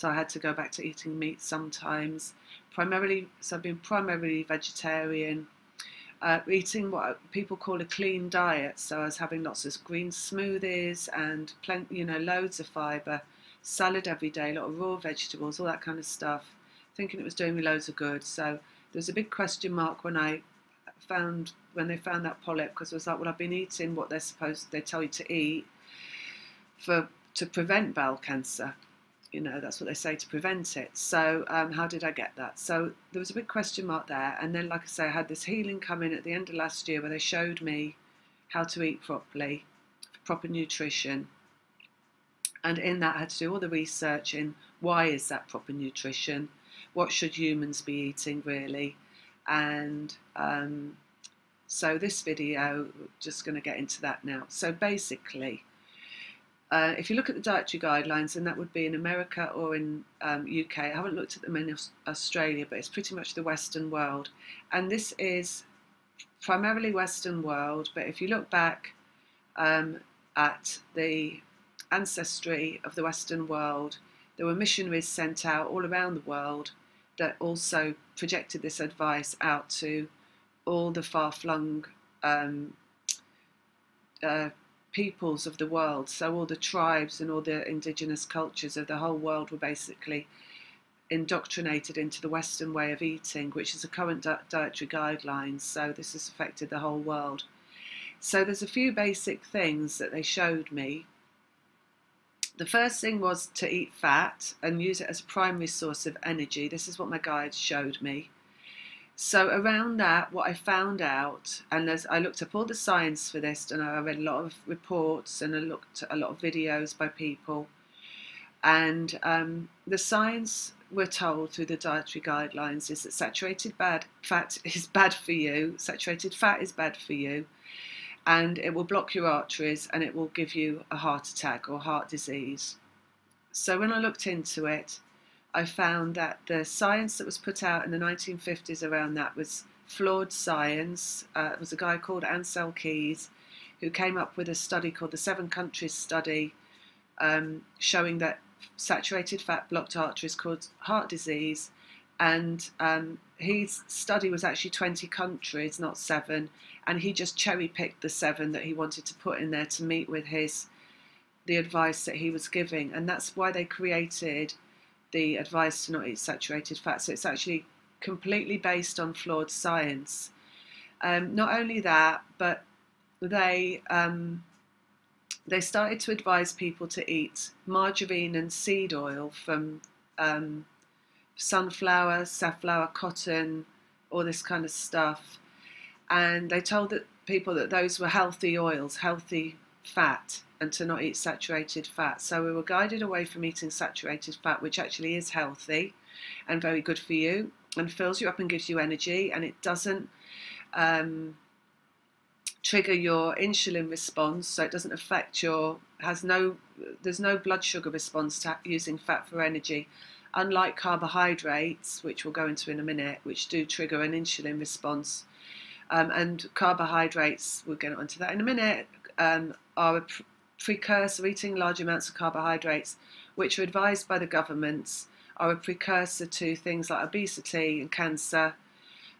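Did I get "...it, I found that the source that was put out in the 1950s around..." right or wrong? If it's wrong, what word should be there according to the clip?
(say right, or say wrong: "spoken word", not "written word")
wrong: "science", not "source".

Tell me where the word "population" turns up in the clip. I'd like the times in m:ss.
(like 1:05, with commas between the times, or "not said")
not said.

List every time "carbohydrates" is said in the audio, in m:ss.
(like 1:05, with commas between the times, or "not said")
3:30, 3:36, 3:42.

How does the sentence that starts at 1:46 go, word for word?
This is what my guide showed me.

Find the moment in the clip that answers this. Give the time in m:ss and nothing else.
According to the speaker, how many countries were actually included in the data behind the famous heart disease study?
2:34.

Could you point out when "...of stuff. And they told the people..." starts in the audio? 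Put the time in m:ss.
3:04.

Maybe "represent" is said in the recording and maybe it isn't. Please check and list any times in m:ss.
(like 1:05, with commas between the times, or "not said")
not said.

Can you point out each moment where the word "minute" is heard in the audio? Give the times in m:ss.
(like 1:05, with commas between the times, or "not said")
3:32, 3:38.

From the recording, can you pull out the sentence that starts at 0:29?
You know, that's what they say to prevent it.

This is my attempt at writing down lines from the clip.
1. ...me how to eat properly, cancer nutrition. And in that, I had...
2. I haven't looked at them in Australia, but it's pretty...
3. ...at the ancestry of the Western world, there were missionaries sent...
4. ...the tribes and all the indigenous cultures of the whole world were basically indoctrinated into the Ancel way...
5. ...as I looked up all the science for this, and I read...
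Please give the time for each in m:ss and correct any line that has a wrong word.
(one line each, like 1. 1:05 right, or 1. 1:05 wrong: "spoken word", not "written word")
1. 0:37 wrong: "proper", not "cancer"
2. 1:00 right
3. 1:10 right
4. 1:26 wrong: "Western", not "Ancel"
5. 1:51 right.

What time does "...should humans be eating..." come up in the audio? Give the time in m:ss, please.
0:47.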